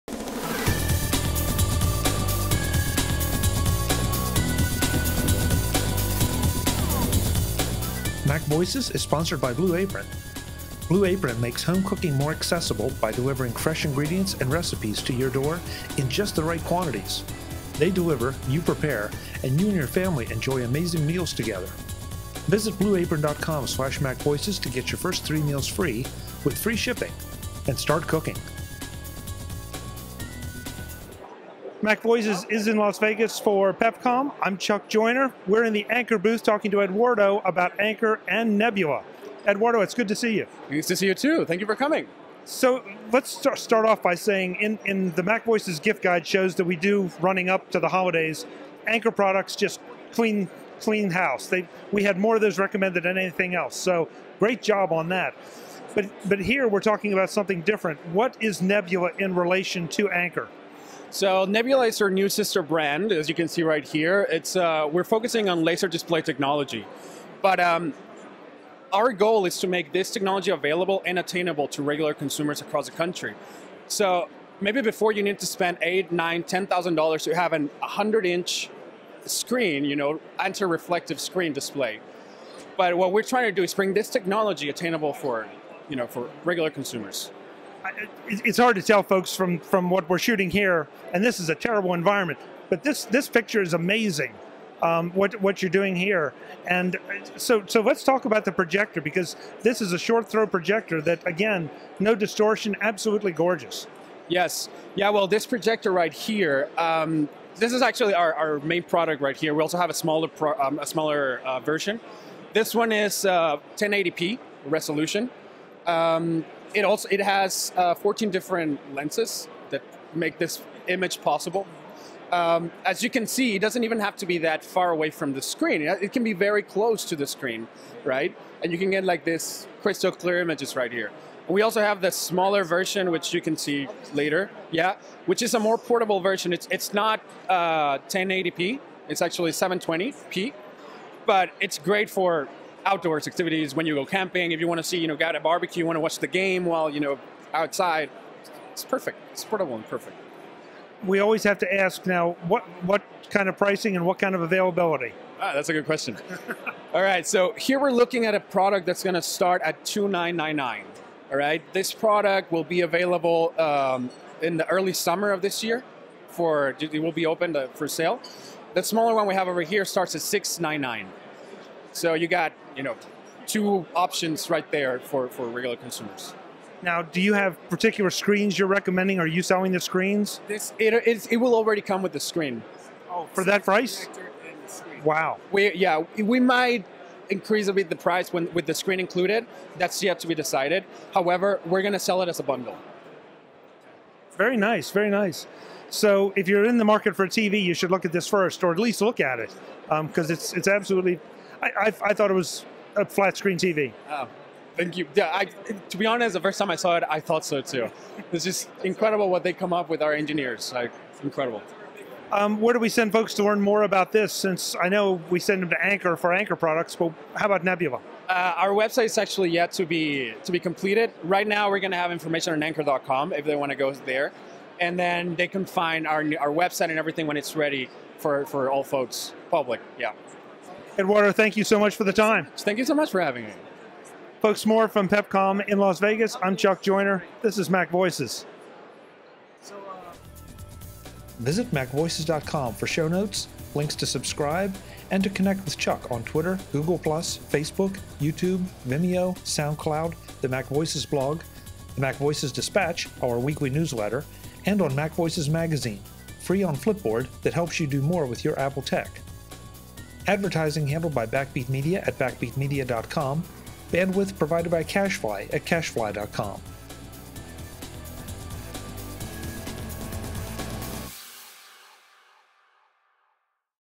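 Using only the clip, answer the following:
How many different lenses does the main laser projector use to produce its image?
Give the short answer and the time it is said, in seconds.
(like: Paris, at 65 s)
14, at 117 s.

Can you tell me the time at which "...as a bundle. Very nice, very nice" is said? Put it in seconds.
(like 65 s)
192 s.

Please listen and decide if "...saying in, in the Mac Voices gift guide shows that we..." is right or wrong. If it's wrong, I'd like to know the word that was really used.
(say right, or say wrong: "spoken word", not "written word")
right.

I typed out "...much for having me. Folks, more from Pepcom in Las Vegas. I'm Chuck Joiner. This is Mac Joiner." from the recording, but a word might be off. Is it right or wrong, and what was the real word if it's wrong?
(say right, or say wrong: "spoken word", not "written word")
wrong: "Voices", not "Joiner".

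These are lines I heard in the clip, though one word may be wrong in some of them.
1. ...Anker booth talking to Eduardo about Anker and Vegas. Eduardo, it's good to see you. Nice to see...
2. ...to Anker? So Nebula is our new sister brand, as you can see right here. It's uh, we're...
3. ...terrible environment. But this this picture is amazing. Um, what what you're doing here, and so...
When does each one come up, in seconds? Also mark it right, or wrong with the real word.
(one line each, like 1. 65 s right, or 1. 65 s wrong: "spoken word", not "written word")
1. 35 s wrong: "Nebula", not "Vegas"
2. 59 s right
3. 91 s right.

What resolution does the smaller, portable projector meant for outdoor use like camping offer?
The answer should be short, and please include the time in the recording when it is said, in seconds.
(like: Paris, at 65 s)
720p, at 139 s.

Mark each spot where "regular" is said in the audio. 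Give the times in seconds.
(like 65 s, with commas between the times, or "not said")
71 s, 86 s, 175 s.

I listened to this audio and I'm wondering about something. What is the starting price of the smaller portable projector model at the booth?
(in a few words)
$699.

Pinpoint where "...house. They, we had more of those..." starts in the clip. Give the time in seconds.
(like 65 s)
51 s.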